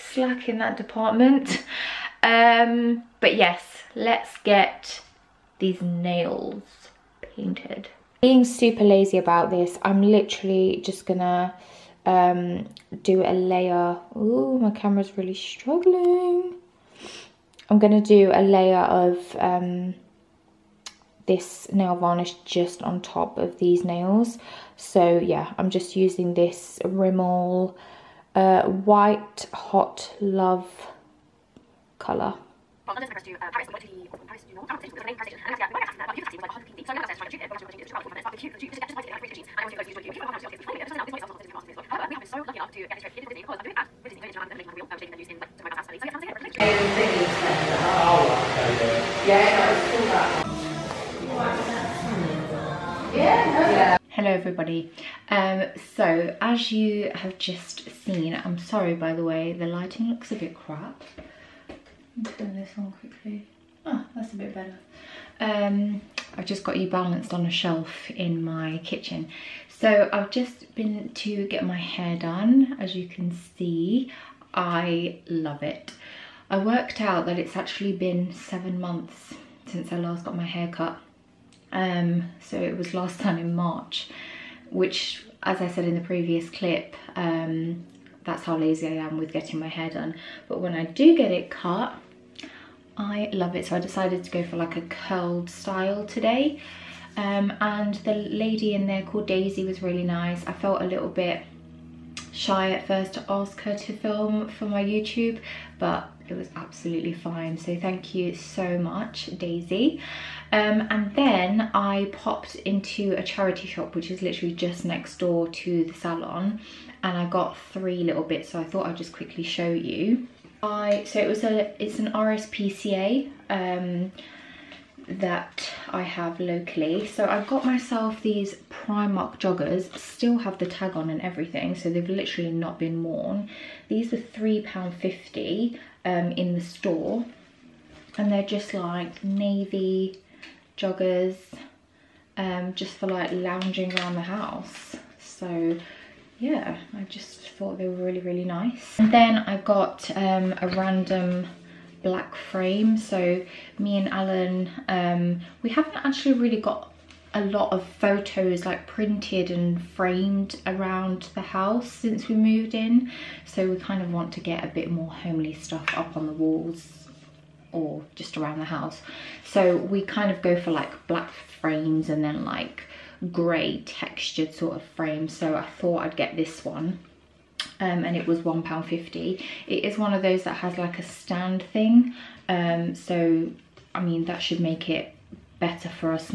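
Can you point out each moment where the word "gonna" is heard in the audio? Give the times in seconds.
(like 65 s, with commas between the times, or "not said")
11 s, 17 s.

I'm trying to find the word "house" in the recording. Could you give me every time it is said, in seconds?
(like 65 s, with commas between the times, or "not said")
144 s, 161 s, 168 s.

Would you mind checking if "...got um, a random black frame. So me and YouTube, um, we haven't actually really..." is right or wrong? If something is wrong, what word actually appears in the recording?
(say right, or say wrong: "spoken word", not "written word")
wrong: "Alan", not "YouTube".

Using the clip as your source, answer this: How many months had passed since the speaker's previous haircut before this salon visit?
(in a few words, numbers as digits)
7.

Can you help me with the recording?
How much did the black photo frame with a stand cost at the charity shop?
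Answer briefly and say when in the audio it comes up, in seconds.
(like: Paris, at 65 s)
£1.50, at 178 s.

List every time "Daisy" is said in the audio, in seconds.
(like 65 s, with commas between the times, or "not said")
99 s, 109 s.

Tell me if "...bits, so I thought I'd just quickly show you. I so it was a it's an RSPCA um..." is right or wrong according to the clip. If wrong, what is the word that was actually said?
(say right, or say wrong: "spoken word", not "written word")
right.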